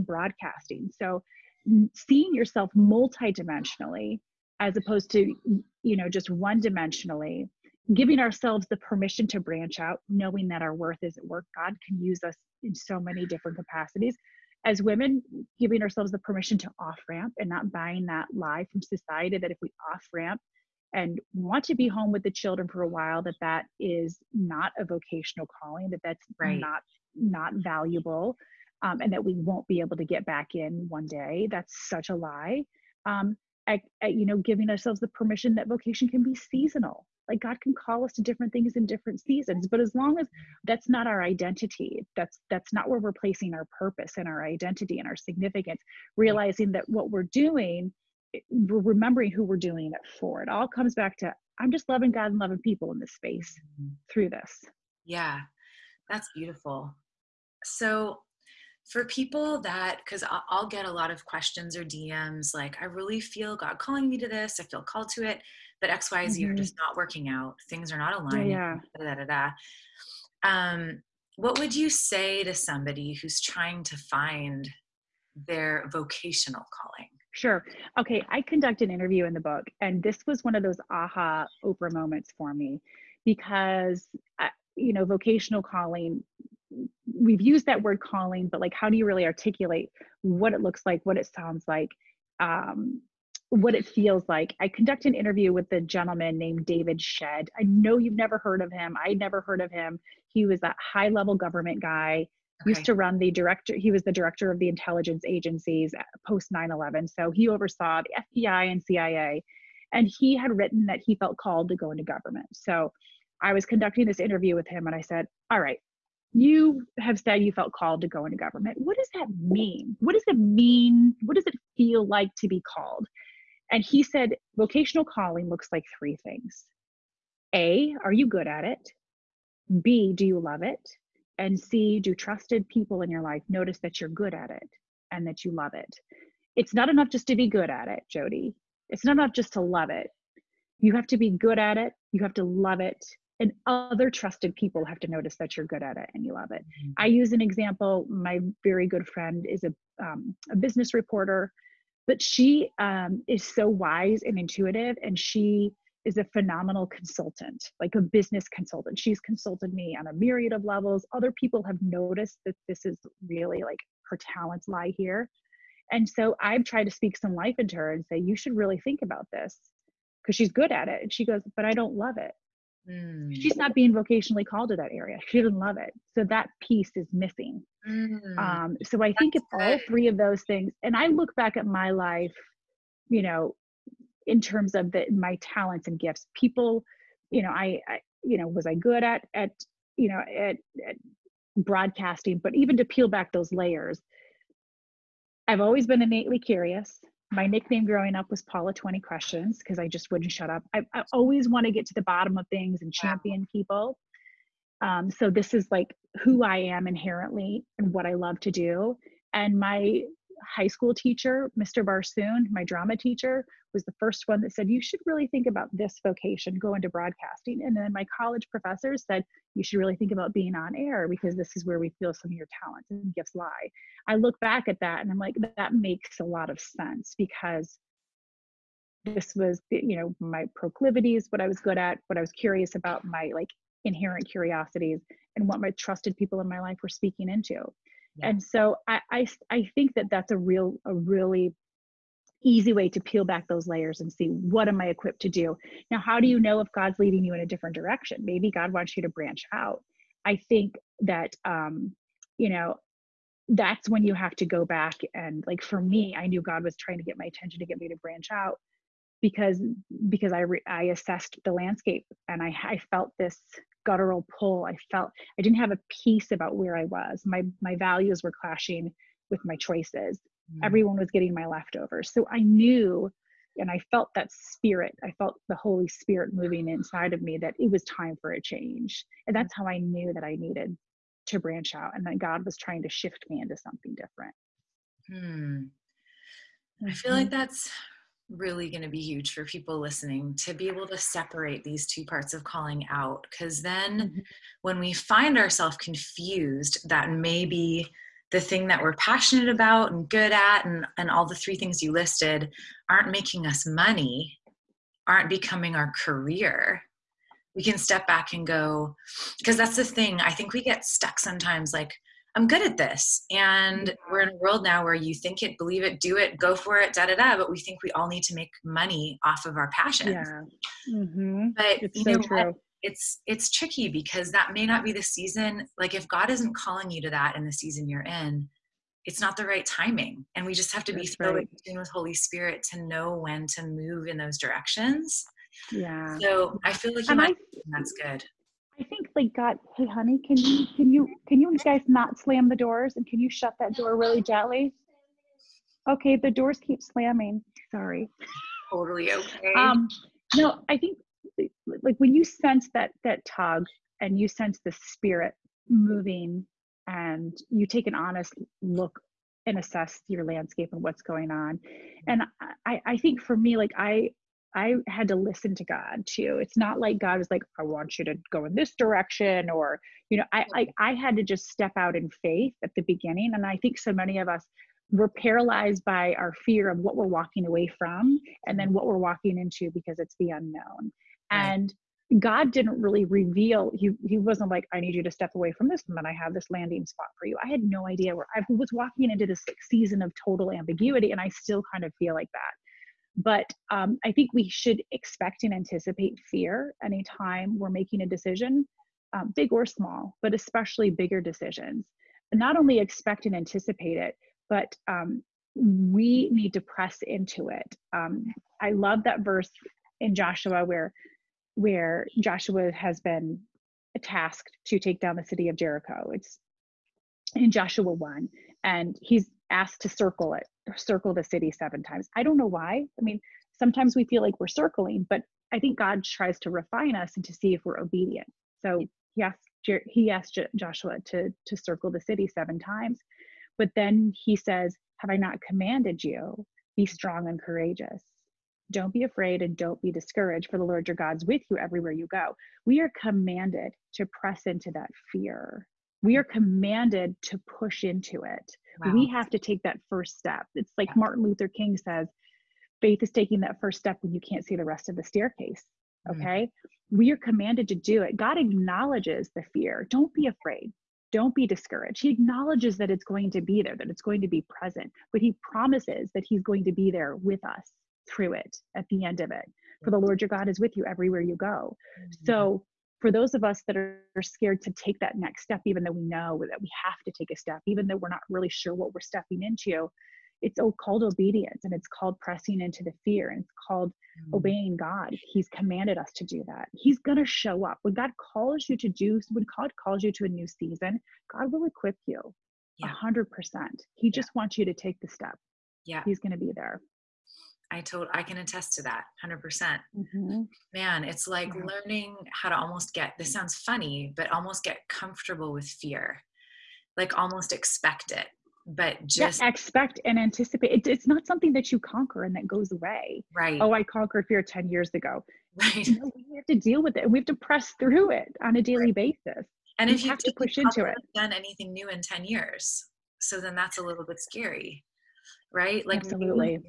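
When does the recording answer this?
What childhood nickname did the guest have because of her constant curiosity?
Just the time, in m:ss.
3:18.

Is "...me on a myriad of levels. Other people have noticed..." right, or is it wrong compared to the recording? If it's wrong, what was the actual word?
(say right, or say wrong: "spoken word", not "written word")
right.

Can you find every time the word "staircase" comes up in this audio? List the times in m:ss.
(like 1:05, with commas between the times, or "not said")
7:35.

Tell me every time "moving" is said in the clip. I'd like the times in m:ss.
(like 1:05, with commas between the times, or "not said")
4:36, 5:55.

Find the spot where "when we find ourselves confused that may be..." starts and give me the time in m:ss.
4:54.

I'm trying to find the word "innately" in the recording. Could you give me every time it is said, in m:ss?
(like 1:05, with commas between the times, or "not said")
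3:16.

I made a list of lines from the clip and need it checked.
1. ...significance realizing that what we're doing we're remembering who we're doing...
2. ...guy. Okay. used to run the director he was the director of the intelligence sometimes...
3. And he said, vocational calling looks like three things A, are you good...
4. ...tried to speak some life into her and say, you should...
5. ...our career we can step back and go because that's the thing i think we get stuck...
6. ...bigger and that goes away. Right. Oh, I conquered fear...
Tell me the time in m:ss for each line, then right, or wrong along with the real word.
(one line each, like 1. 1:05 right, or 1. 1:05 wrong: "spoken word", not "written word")
1. 0:45 right
2. 1:41 wrong: "agencies", not "sometimes"
3. 2:03 right
4. 2:46 right
5. 5:05 right
6. 8:31 wrong: "conquer", not "bigger".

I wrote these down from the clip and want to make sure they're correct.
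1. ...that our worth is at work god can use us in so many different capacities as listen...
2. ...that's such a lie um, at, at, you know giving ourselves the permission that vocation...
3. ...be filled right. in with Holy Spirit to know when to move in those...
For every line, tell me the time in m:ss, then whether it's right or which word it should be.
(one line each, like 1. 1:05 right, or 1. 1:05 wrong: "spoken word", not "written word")
1. 0:10 wrong: "women", not "listen"
2. 0:31 right
3. 5:31 right.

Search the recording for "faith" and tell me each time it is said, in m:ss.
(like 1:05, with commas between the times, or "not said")
6:12, 7:32.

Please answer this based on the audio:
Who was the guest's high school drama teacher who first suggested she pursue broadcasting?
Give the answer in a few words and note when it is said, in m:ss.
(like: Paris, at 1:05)
Mr. Barsoon, at 3:31.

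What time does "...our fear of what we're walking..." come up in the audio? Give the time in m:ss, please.
6:16.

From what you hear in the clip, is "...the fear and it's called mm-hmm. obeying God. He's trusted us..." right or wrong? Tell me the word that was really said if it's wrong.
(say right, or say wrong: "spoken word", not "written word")
wrong: "commanded", not "trusted".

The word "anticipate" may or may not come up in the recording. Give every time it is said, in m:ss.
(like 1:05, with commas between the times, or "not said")
6:35, 6:43, 8:30.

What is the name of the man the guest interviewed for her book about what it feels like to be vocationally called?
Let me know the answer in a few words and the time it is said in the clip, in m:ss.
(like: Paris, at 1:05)
David Shedd, at 1:36.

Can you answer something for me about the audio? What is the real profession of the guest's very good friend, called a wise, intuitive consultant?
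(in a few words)
business reporter.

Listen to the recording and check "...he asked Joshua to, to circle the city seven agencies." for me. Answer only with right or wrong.
wrong.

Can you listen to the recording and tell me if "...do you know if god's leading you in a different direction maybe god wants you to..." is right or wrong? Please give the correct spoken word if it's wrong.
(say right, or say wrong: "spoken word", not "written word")
right.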